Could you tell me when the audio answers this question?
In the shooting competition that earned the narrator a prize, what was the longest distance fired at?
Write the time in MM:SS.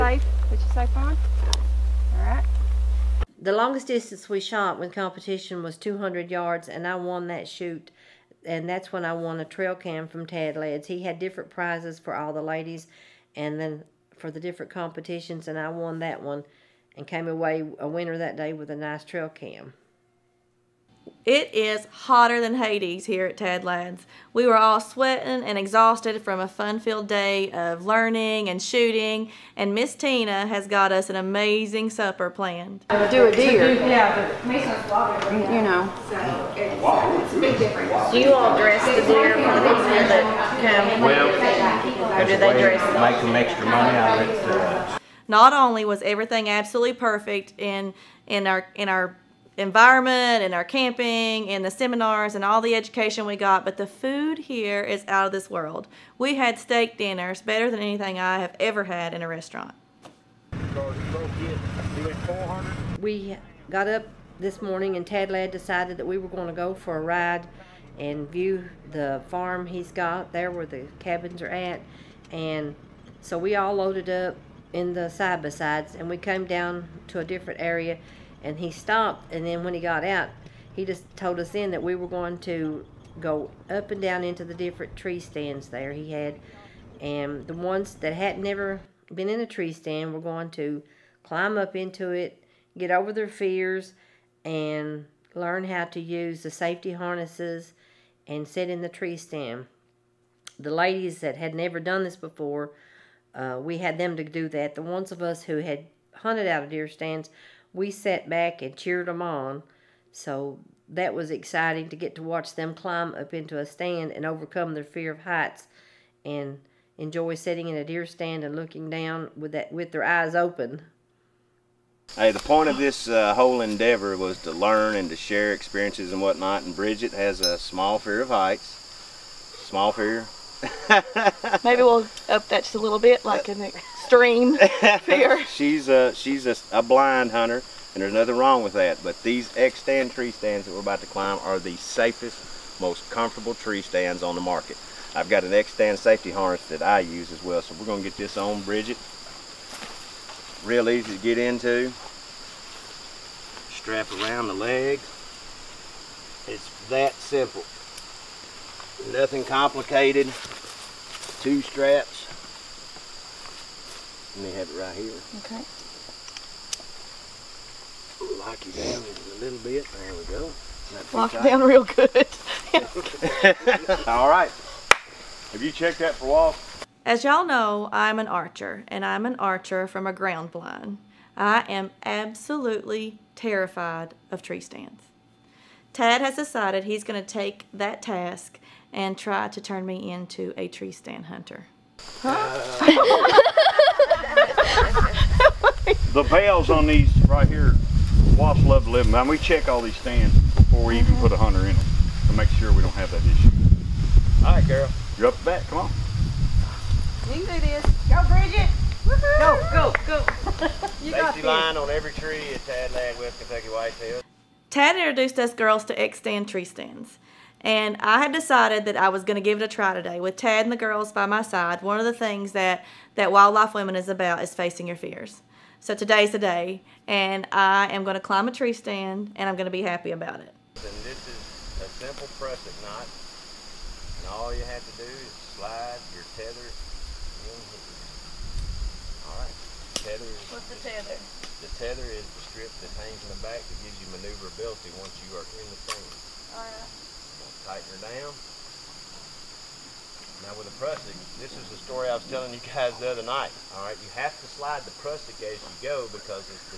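00:05.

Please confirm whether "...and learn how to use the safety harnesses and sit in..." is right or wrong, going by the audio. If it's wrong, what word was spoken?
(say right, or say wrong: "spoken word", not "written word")
right.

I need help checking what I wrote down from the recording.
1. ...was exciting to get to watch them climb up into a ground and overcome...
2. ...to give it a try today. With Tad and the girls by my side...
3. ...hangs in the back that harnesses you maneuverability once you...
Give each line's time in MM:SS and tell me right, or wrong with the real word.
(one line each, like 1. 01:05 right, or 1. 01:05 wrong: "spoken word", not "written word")
1. 01:51 wrong: "stand", not "ground"
2. 03:39 right
3. 04:02 wrong: "gives", not "harnesses".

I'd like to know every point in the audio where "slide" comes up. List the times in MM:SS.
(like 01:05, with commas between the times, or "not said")
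03:55, 04:14.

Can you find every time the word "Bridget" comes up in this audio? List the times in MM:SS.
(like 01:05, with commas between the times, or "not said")
02:06, 02:28, 03:28.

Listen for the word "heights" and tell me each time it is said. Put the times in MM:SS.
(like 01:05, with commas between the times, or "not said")
01:55, 02:08.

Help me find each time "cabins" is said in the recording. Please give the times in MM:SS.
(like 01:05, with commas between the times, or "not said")
01:10.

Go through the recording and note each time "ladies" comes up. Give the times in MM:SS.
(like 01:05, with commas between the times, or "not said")
00:12, 01:40.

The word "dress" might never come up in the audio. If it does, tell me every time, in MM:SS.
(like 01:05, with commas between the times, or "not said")
00:38, 00:42.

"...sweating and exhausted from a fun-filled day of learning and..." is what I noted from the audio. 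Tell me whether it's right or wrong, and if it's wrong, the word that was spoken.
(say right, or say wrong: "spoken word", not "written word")
right.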